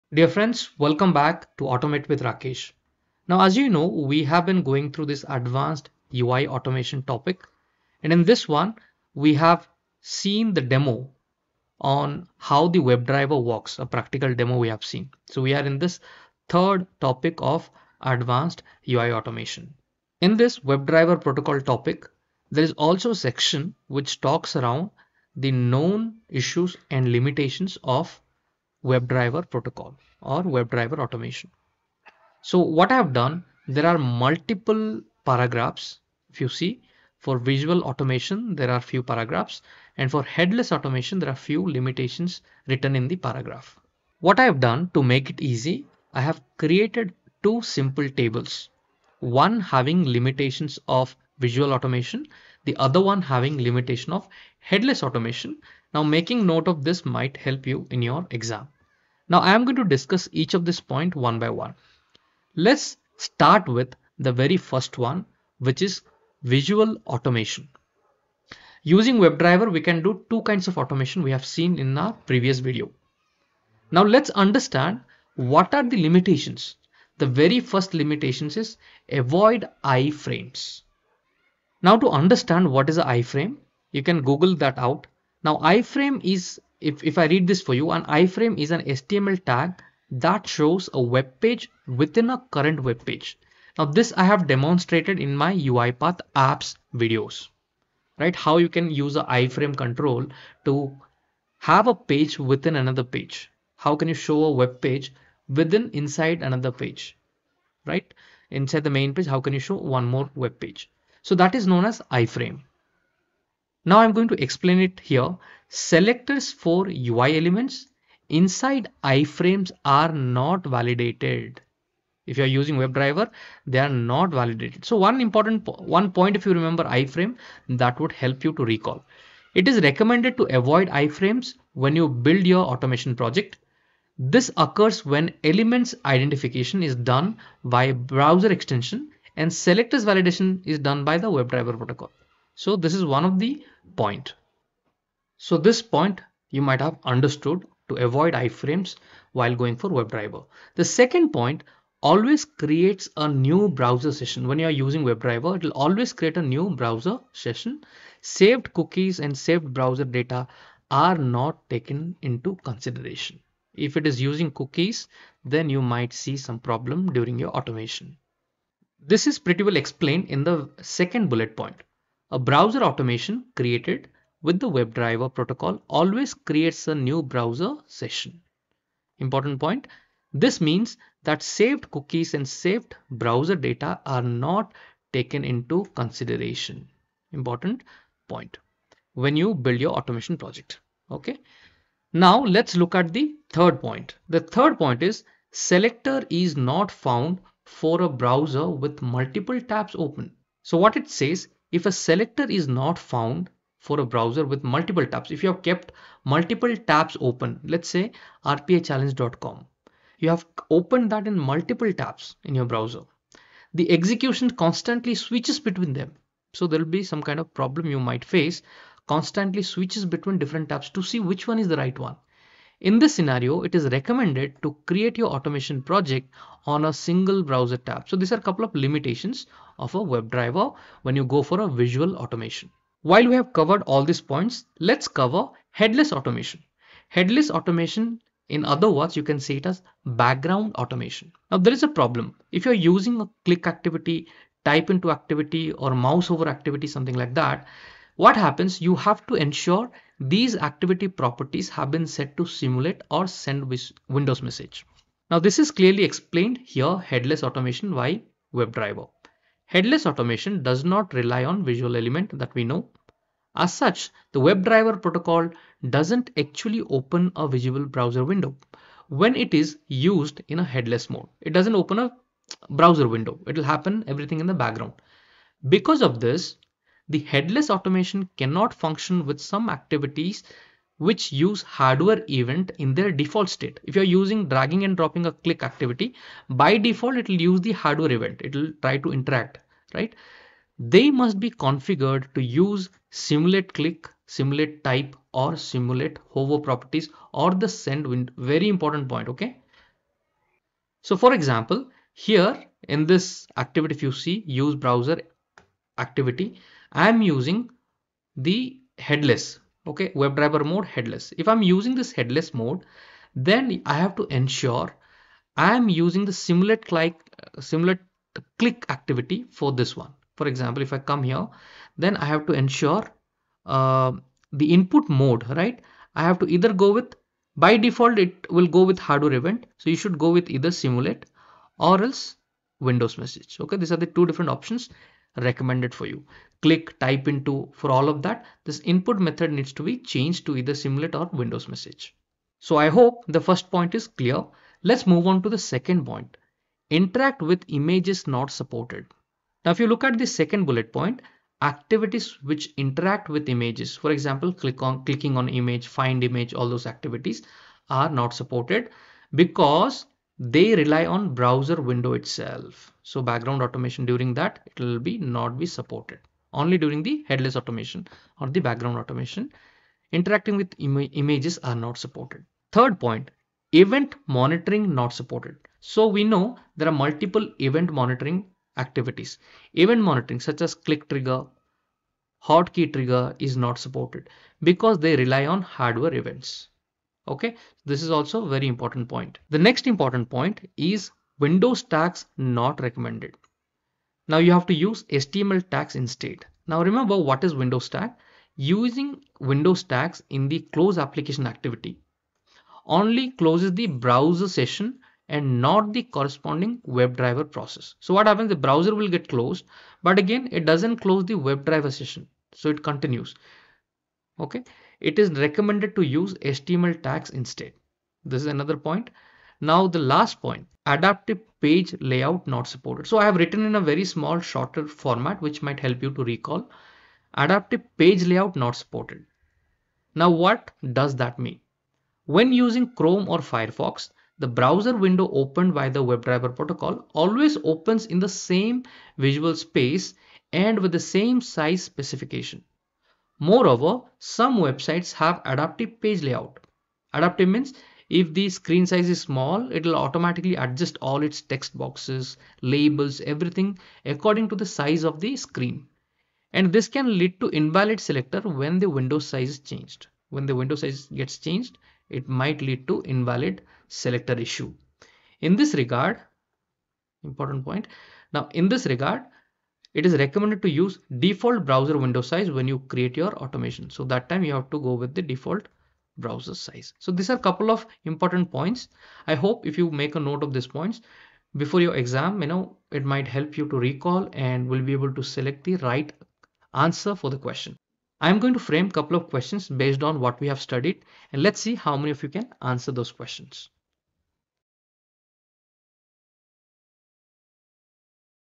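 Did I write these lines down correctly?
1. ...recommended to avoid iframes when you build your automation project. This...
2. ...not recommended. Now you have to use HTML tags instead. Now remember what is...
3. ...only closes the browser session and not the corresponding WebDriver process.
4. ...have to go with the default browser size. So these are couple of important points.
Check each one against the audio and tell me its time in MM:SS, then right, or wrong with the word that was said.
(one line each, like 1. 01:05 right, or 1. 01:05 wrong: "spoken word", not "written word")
1. 02:09 right
2. 06:32 right
3. 06:42 right
4. 07:54 right.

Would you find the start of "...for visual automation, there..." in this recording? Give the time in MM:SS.
00:37.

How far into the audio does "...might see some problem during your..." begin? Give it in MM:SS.
02:45.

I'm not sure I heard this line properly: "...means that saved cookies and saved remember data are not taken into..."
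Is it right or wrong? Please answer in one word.
wrong.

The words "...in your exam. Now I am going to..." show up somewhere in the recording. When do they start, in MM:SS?
00:57.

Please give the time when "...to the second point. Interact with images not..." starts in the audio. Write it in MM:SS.
05:45.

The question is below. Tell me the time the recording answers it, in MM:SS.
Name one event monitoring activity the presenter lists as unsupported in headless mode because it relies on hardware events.
06:22.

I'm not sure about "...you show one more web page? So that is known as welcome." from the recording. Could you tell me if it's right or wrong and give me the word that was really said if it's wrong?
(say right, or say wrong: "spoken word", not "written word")
wrong: "iframe", not "welcome".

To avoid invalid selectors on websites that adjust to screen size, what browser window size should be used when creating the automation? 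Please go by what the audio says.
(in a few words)
Default browser window size.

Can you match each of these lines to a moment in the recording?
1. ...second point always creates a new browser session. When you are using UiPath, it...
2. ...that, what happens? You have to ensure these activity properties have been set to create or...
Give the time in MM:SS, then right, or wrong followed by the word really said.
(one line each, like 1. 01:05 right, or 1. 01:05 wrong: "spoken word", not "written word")
1. 02:30 wrong: "WebDriver", not "UiPath"
2. 04:07 wrong: "simulate", not "create".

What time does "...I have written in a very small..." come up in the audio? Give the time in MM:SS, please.
07:03.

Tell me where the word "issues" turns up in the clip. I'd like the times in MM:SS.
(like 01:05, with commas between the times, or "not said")
00:26, 07:44.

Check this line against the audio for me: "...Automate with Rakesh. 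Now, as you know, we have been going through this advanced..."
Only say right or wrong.
right.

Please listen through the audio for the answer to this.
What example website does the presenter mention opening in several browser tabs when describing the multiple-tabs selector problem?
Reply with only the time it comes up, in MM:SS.
03:28.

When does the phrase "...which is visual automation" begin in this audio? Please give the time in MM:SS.
01:05.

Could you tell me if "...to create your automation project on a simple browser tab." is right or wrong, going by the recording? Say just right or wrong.
wrong.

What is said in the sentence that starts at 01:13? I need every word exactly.
Now let's understand what are the limitations.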